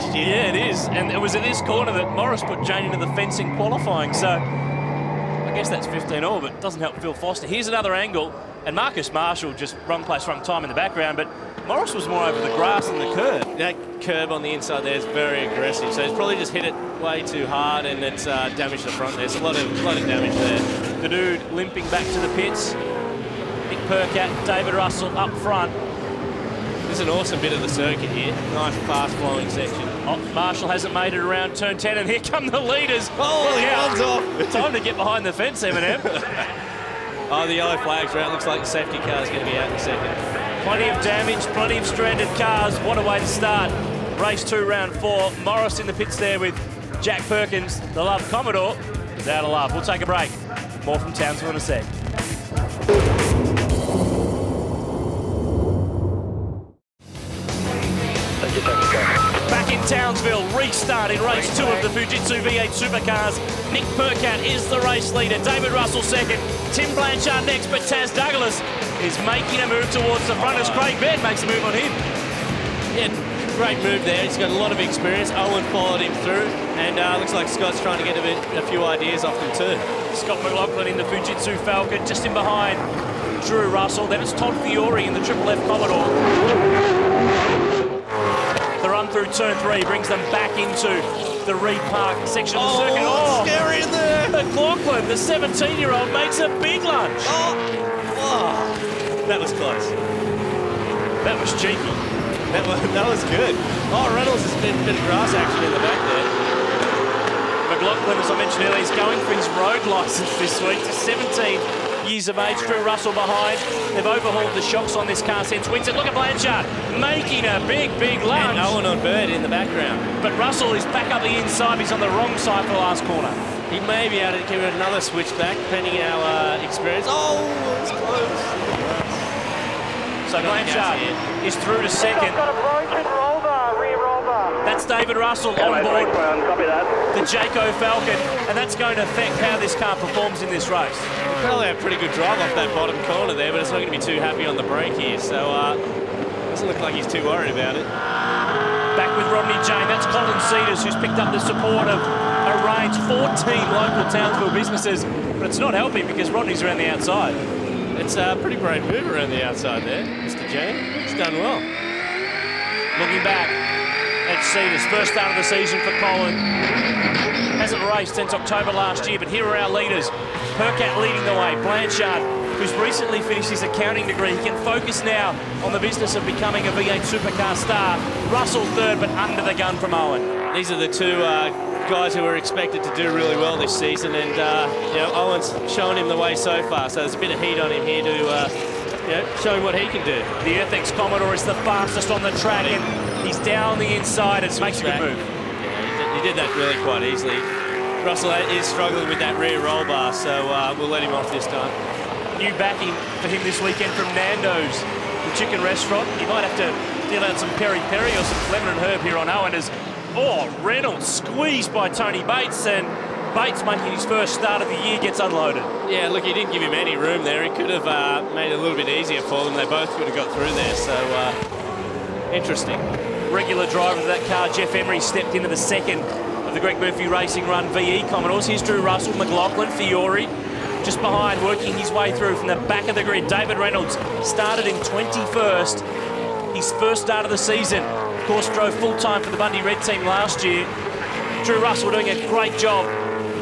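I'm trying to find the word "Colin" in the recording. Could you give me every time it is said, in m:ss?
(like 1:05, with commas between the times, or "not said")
2:30, 2:45.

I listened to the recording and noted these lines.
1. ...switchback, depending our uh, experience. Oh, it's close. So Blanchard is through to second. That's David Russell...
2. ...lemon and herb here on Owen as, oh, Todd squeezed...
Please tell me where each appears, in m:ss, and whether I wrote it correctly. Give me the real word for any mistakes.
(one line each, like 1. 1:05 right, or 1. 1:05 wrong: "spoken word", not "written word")
1. 2:04 right
2. 3:28 wrong: "Reynolds", not "Todd".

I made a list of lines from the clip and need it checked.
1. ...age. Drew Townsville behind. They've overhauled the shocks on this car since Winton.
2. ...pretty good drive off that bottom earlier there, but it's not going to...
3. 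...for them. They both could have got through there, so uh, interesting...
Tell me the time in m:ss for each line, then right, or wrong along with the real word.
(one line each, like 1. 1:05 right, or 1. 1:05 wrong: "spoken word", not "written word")
1. 1:52 wrong: "Russell", not "Townsville"
2. 2:21 wrong: "corner", not "earlier"
3. 3:39 right.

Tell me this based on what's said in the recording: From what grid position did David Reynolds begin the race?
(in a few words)
21st.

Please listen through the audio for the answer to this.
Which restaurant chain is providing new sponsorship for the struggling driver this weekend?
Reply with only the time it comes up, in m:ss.
3:24.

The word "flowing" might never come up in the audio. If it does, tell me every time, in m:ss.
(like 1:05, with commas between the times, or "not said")
0:28.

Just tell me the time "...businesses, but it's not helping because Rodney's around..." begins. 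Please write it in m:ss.
2:34.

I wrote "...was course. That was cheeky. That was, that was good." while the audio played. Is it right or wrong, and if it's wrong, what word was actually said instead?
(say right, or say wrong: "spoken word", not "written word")
wrong: "close", not "course".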